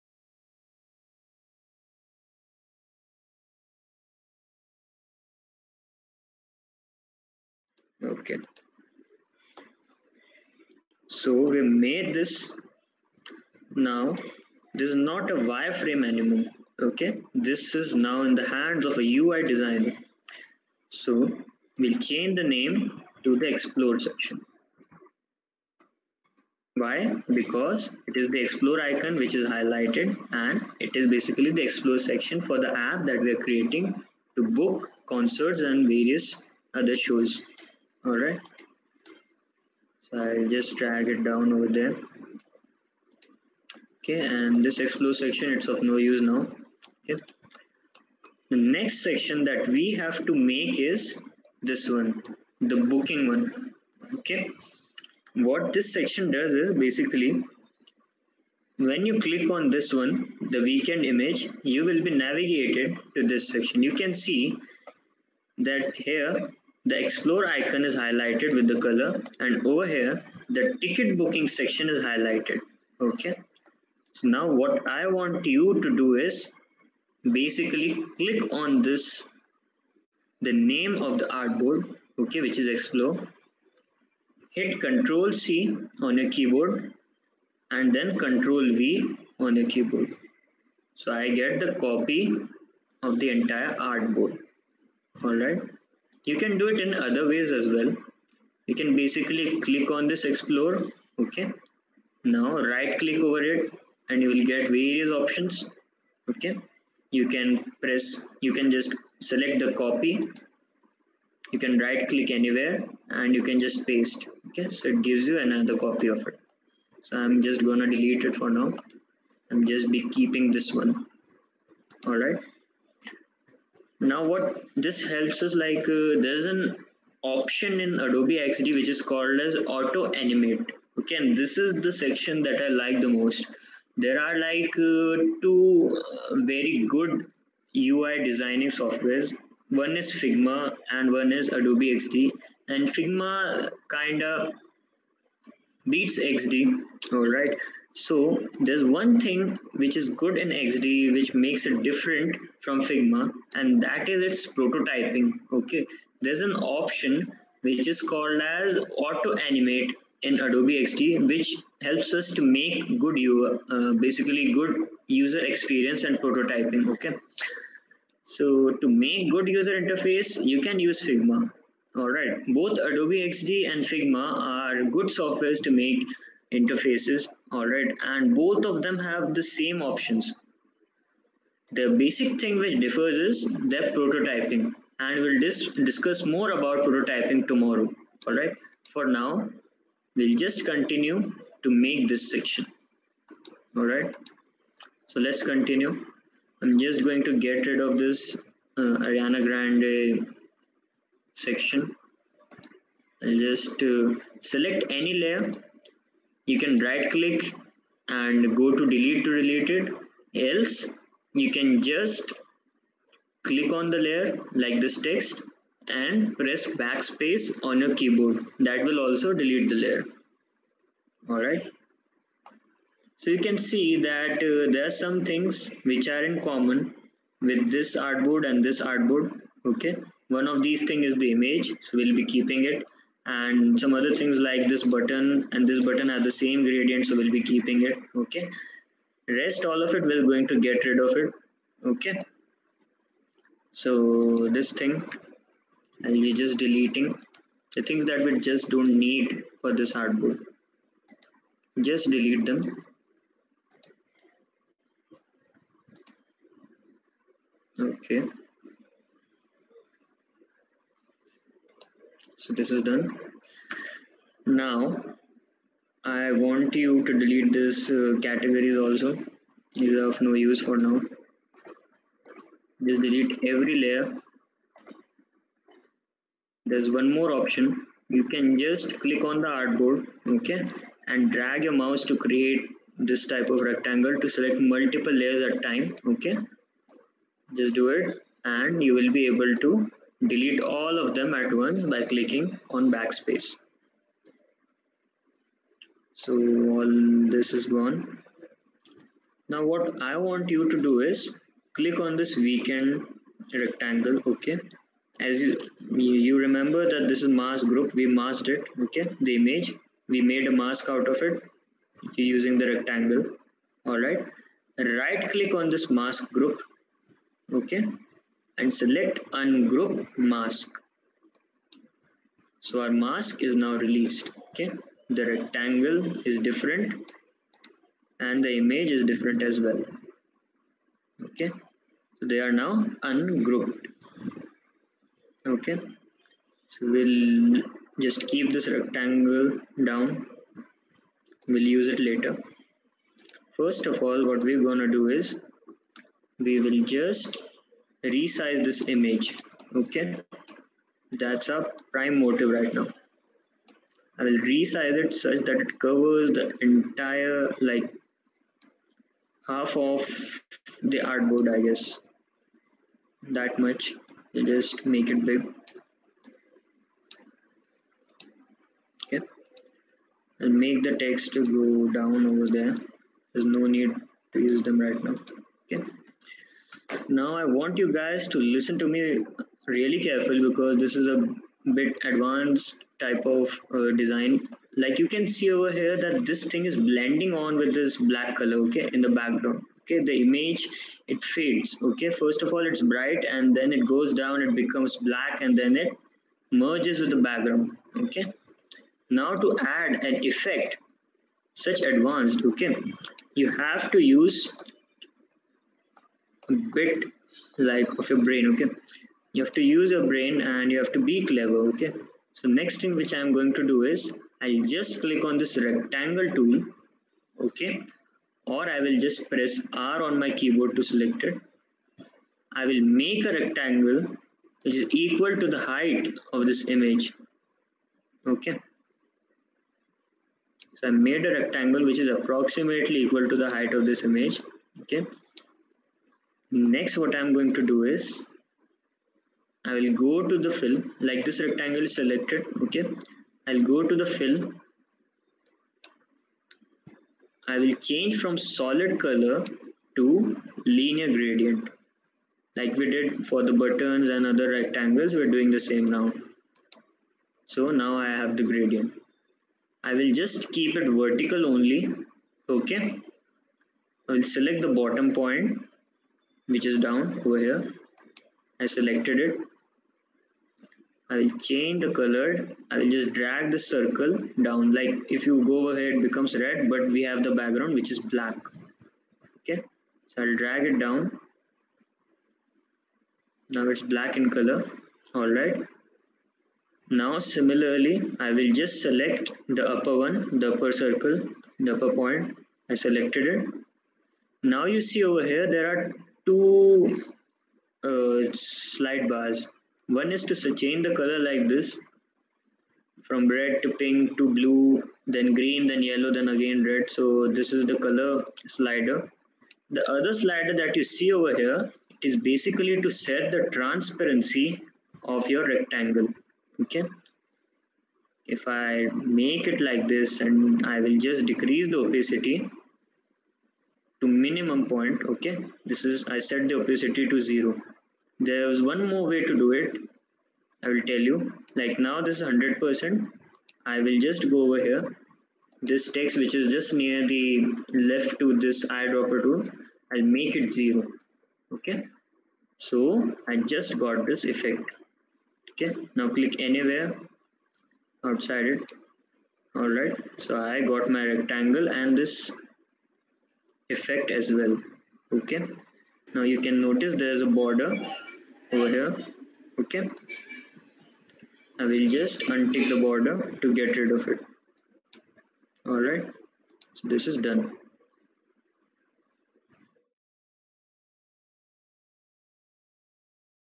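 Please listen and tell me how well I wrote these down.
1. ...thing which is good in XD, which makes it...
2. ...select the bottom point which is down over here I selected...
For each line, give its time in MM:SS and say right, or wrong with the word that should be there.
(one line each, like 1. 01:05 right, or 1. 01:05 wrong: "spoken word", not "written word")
1. 02:29 right
2. 07:44 right.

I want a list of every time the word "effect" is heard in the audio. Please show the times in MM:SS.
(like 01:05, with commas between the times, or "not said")
06:40, 09:04, 09:13.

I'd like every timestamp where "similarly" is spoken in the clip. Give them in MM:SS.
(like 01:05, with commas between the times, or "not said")
08:07.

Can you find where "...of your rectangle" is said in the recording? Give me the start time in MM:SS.
08:35.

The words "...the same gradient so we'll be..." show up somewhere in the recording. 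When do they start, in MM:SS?
03:56.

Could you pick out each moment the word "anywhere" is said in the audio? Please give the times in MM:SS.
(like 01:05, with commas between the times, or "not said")
01:52, 09:06.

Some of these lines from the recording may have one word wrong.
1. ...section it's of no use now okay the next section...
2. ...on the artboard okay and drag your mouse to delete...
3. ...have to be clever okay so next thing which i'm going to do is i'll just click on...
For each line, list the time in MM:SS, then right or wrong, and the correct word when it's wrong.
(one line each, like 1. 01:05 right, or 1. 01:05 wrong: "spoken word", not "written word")
1. 00:45 right
2. 04:39 wrong: "create", not "delete"
3. 06:50 right.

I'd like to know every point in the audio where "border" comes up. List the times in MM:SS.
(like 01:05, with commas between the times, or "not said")
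09:17, 09:22.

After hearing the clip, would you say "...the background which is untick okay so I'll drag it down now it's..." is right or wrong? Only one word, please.
wrong.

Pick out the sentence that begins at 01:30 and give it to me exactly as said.
So I get the copy of the entire artboard.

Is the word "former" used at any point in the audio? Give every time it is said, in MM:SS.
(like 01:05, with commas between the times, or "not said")
not said.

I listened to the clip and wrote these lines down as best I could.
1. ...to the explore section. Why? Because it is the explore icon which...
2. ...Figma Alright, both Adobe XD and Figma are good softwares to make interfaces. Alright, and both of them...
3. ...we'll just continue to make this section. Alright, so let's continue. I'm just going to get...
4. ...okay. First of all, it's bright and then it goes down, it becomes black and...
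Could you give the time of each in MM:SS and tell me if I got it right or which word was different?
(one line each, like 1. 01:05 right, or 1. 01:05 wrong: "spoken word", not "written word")
1. 00:23 right
2. 02:51 right
3. 03:10 right
4. 06:31 right.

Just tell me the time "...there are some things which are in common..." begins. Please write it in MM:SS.
03:44.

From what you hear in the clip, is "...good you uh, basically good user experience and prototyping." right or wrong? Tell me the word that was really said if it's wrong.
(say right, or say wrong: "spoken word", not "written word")
right.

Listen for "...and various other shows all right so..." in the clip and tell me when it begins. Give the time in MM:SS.
00:35.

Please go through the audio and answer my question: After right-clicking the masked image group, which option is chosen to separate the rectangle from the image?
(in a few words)
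Ungroup mask.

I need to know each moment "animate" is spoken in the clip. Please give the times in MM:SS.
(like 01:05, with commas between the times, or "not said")
02:10, 02:39.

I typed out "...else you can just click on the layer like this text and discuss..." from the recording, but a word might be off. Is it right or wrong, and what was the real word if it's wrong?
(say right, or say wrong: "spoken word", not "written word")
wrong: "press", not "discuss".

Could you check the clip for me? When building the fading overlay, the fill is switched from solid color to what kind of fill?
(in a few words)
Linear gradient.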